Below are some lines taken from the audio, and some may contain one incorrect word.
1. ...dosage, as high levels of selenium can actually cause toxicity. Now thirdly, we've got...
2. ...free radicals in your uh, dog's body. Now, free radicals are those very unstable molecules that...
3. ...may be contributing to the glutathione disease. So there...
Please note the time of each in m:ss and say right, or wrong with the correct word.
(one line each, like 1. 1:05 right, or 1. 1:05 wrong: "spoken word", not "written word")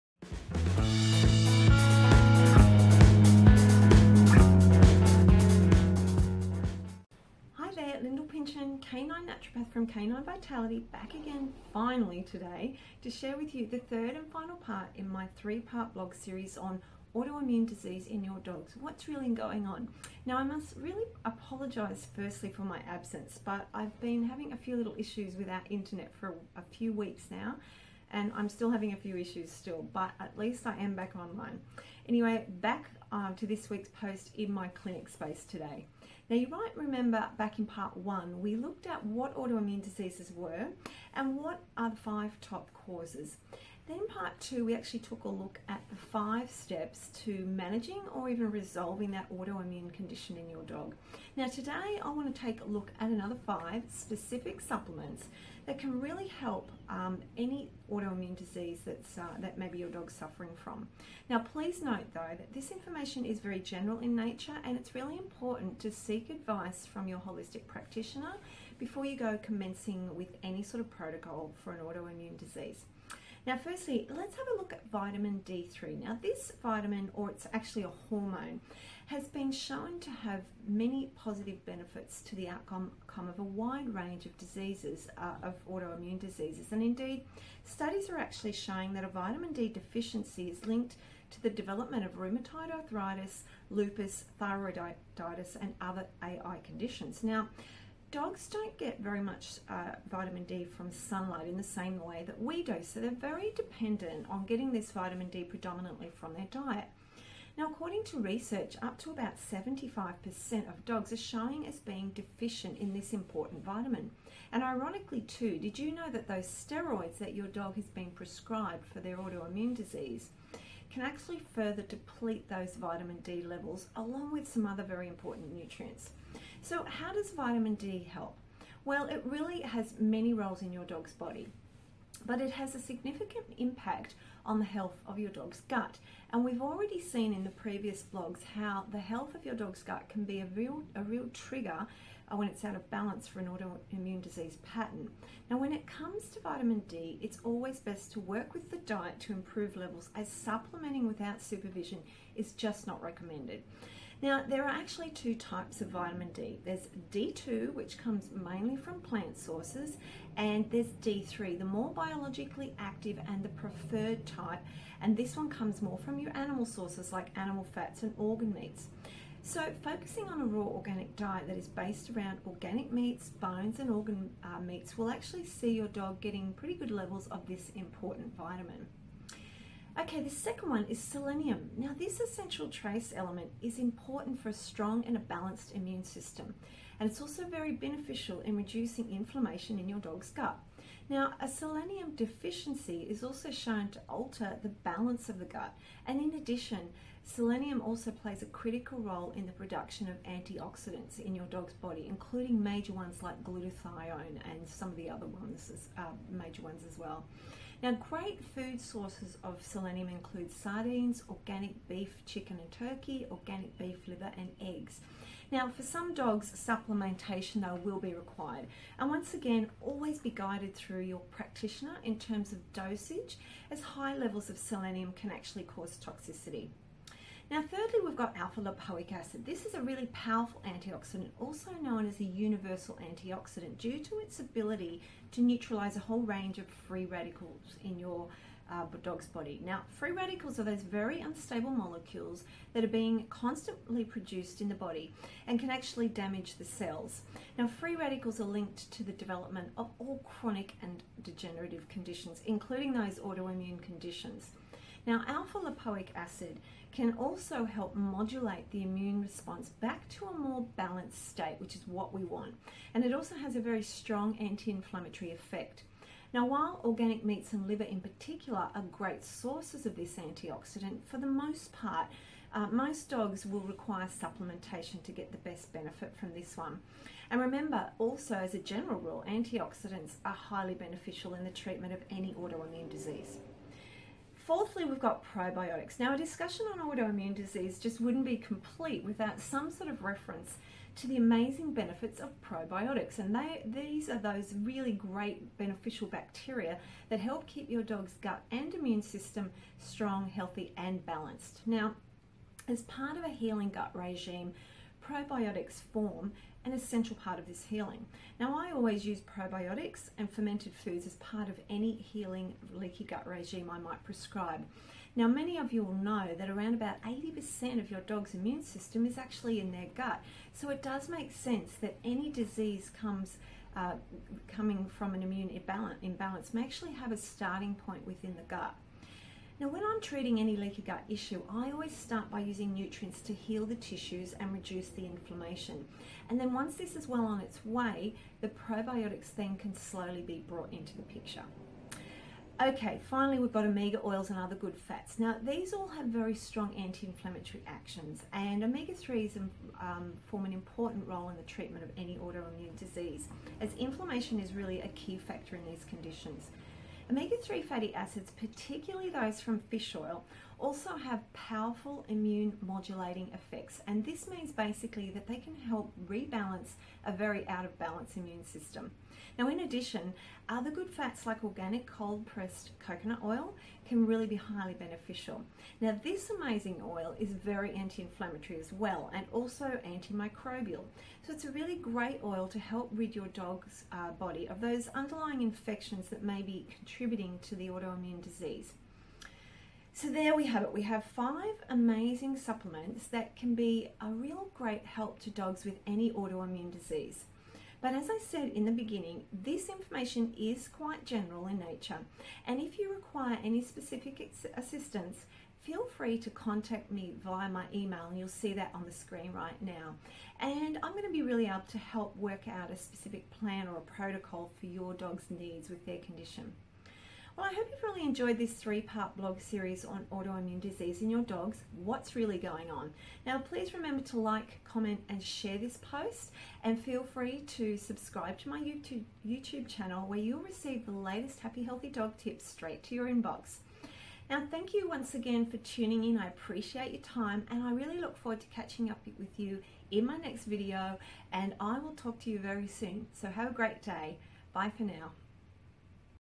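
1. 3:42 right
2. 3:56 right
3. 6:26 wrong: "autoimmune", not "glutathione".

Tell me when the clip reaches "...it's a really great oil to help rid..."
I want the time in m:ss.
6:21.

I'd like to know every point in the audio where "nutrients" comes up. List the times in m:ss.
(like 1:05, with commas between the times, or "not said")
2:05, 5:32.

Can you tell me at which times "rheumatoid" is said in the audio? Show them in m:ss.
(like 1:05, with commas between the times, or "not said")
1:32.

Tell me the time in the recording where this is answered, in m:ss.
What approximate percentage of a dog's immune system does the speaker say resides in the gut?
5:17.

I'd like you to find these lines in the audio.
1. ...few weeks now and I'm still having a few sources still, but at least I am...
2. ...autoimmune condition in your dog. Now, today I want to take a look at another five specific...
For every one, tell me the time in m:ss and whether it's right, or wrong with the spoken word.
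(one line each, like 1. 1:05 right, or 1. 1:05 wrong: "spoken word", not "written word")
1. 0:26 wrong: "issues", not "sources"
2. 0:49 right.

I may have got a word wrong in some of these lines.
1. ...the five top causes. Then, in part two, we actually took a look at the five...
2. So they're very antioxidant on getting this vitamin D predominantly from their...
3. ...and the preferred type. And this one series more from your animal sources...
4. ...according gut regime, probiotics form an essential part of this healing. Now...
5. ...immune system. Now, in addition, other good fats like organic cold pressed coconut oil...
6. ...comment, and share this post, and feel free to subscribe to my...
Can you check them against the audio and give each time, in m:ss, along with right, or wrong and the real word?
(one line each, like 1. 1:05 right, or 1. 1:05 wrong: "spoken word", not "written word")
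1. 0:41 right
2. 1:42 wrong: "dependent", not "antioxidant"
3. 2:43 wrong: "comes", not "series"
4. 5:03 wrong: "healing", not "according"
5. 6:08 right
6. 7:04 right.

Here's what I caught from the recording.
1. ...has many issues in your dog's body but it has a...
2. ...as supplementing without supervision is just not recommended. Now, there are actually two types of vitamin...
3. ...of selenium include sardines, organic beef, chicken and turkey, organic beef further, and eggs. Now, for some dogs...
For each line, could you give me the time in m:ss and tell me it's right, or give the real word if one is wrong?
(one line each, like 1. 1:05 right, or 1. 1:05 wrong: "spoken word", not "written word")
1. 2:09 wrong: "roles", not "issues"
2. 2:30 right
3. 3:29 wrong: "liver", not "further".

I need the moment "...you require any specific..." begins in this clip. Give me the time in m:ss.
6:42.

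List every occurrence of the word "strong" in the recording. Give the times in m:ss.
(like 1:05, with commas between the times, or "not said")
3:04, 4:23, 4:59, 5:46.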